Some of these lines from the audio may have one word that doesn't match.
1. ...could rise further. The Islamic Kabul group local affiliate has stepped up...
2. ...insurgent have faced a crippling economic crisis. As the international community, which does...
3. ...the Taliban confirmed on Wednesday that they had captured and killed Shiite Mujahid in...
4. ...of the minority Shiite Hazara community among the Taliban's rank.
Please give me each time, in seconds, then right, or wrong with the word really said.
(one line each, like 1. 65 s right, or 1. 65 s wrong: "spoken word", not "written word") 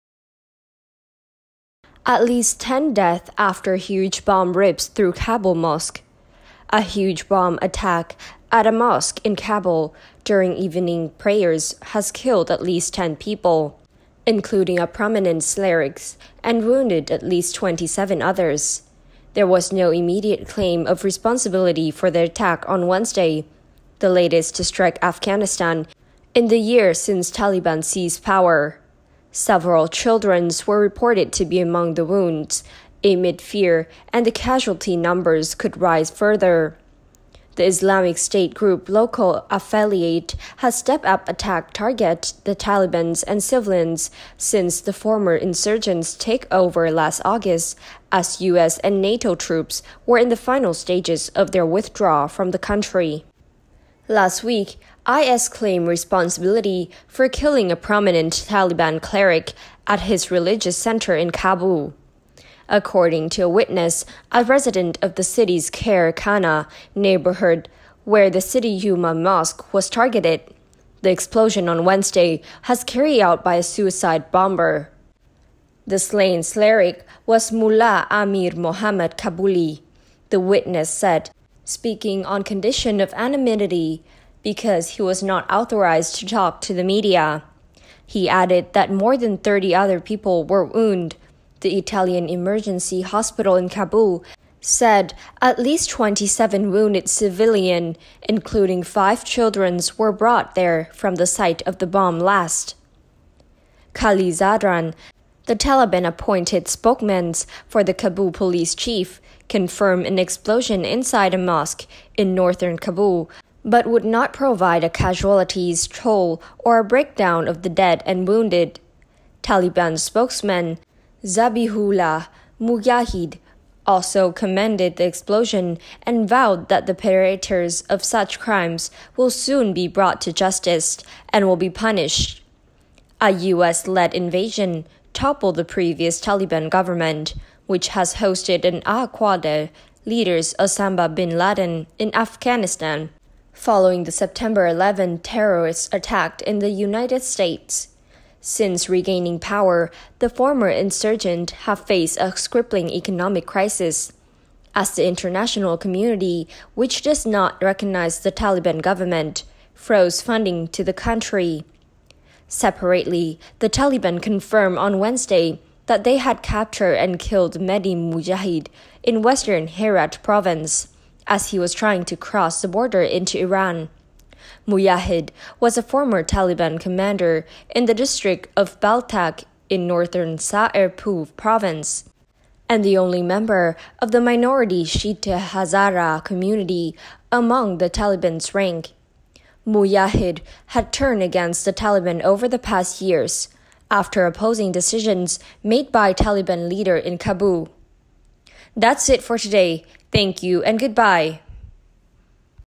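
1. 35 s wrong: "State", not "Kabul"
2. 150 s right
3. 163 s wrong: "Mehdi", not "Shiite"
4. 183 s right.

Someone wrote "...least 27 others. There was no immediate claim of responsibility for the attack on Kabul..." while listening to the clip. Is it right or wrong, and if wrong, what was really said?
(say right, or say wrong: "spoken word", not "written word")
wrong: "Wednesday", not "Kabul".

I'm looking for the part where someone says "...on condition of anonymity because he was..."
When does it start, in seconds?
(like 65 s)
82 s.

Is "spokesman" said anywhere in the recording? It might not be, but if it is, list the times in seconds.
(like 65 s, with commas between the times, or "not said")
106 s, 119 s.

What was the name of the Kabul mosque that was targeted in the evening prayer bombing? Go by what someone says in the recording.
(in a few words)
City Yuma Mosque.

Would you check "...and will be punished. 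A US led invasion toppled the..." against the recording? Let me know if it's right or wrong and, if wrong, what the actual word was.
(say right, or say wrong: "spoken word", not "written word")
right.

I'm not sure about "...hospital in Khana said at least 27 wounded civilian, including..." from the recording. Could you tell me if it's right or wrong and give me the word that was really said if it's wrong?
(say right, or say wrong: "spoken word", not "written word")
wrong: "Kabul", not "Khana".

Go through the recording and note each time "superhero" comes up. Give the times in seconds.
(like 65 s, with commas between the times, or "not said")
not said.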